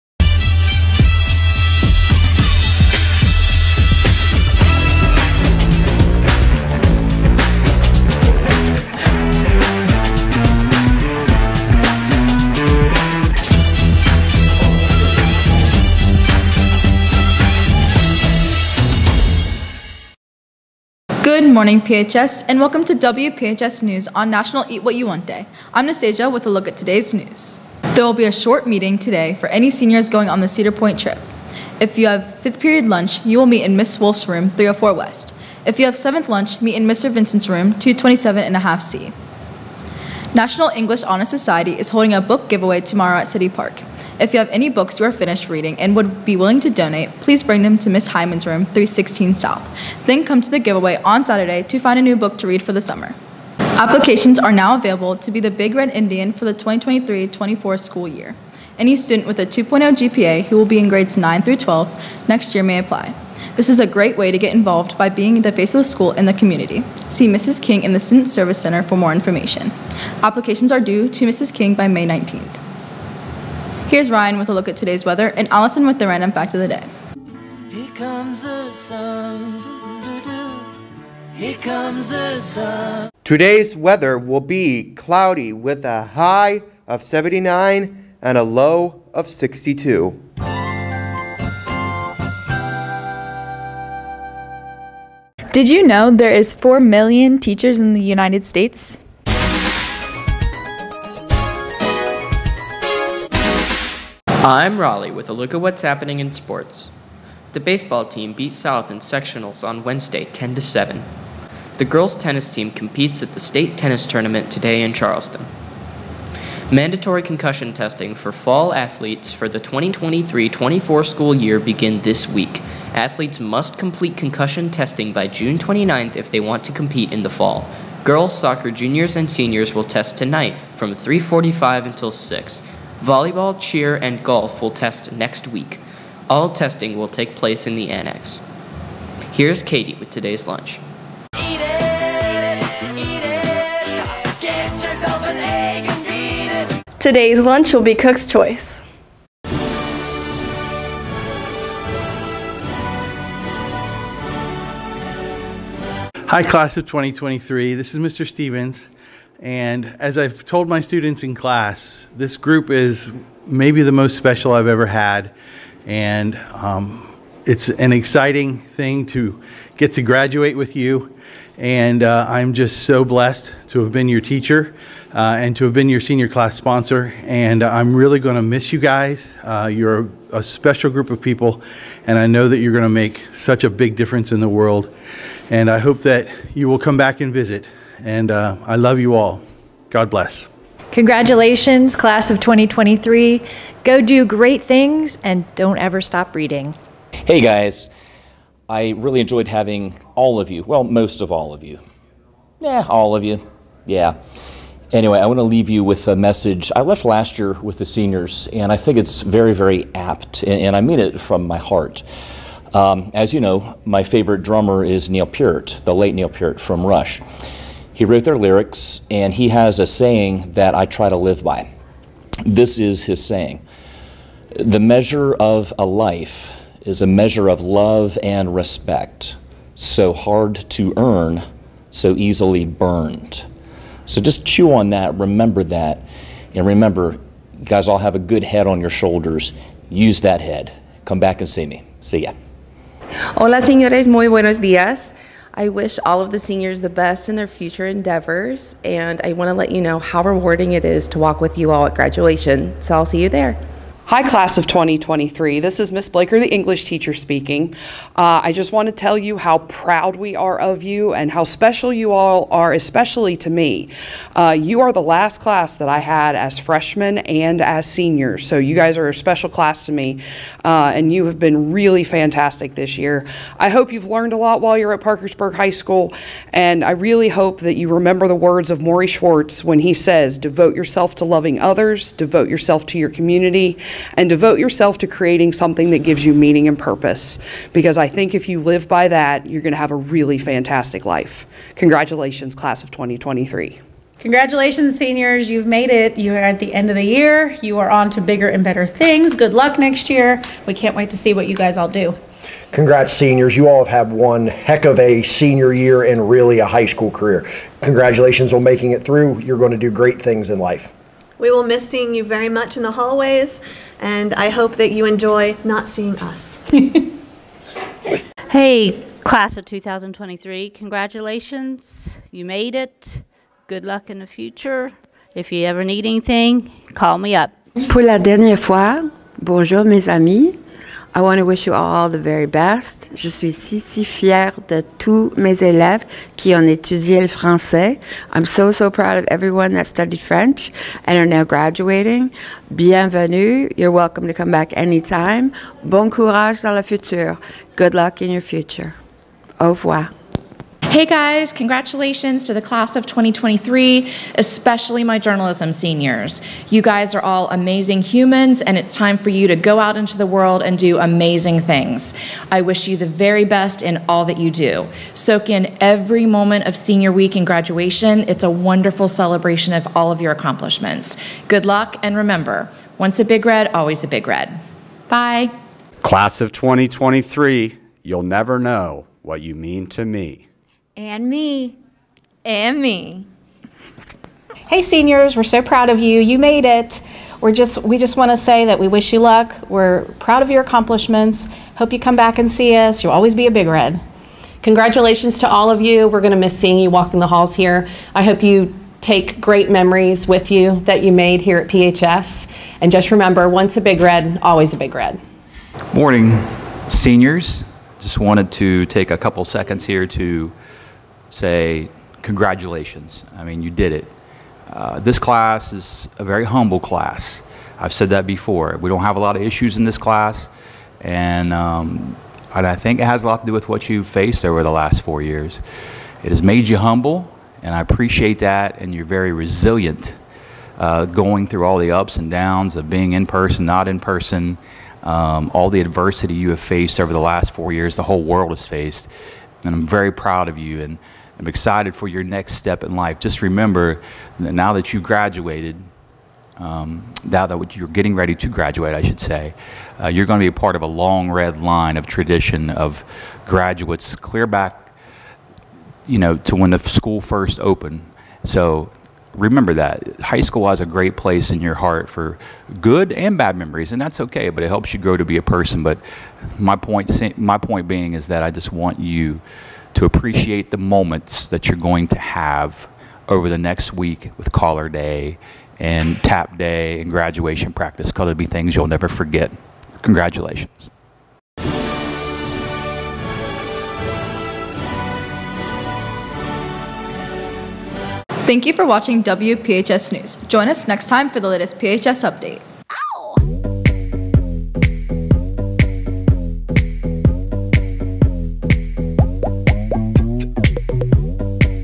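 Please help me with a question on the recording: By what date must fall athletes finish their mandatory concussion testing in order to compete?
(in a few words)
June 29th.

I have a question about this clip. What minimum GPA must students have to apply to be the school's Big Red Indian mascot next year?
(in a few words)
2.0.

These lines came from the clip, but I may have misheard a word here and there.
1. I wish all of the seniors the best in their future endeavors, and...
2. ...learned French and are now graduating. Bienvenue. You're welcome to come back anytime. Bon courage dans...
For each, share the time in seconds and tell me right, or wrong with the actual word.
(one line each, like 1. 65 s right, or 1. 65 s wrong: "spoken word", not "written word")
1. 245 s right
2. 339 s wrong: "studied", not "learned".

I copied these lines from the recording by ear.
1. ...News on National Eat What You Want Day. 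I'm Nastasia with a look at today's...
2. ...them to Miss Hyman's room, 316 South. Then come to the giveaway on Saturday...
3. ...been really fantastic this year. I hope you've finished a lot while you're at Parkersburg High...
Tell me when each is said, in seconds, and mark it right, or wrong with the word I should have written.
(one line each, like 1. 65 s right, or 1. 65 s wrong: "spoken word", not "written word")
1. 23 s right
2. 47 s right
3. 271 s wrong: "learned", not "finished".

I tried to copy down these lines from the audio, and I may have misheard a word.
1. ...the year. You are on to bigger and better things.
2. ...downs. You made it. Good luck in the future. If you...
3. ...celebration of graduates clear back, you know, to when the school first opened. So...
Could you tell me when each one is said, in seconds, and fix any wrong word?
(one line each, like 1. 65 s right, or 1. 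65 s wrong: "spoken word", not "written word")
1. 296 s right
2. 320 s wrong: "congratulations", not "downs"
3. 452 s wrong: "tradition", not "celebration".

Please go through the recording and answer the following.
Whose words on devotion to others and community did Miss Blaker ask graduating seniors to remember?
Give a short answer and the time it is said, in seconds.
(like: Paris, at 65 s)
Morrie Schwartz, at 278 s.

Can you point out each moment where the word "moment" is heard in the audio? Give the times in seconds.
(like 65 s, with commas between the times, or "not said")
366 s, 470 s.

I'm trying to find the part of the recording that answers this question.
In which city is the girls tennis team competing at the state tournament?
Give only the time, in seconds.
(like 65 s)
114 s.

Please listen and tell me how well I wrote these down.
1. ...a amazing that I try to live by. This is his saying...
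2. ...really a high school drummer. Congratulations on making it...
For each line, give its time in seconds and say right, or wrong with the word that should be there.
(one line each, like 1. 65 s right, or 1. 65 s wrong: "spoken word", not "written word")
1. 219 s wrong: "saying", not "amazing"
2. 306 s wrong: "career", not "drummer".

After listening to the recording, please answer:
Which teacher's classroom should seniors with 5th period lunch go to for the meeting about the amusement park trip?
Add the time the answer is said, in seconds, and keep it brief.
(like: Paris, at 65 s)
Miss Wolf, at 33 s.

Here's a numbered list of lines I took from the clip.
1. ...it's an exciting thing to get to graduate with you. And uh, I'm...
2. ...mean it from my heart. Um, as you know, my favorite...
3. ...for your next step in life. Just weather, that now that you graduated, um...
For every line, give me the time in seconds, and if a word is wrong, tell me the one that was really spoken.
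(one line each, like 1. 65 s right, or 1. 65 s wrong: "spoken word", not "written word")
1. 167 s right
2. 210 s right
3. 441 s wrong: "remember", not "weather".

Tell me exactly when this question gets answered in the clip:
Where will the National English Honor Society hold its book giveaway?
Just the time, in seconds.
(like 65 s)
43 s.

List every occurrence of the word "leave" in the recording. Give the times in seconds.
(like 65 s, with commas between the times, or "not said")
205 s.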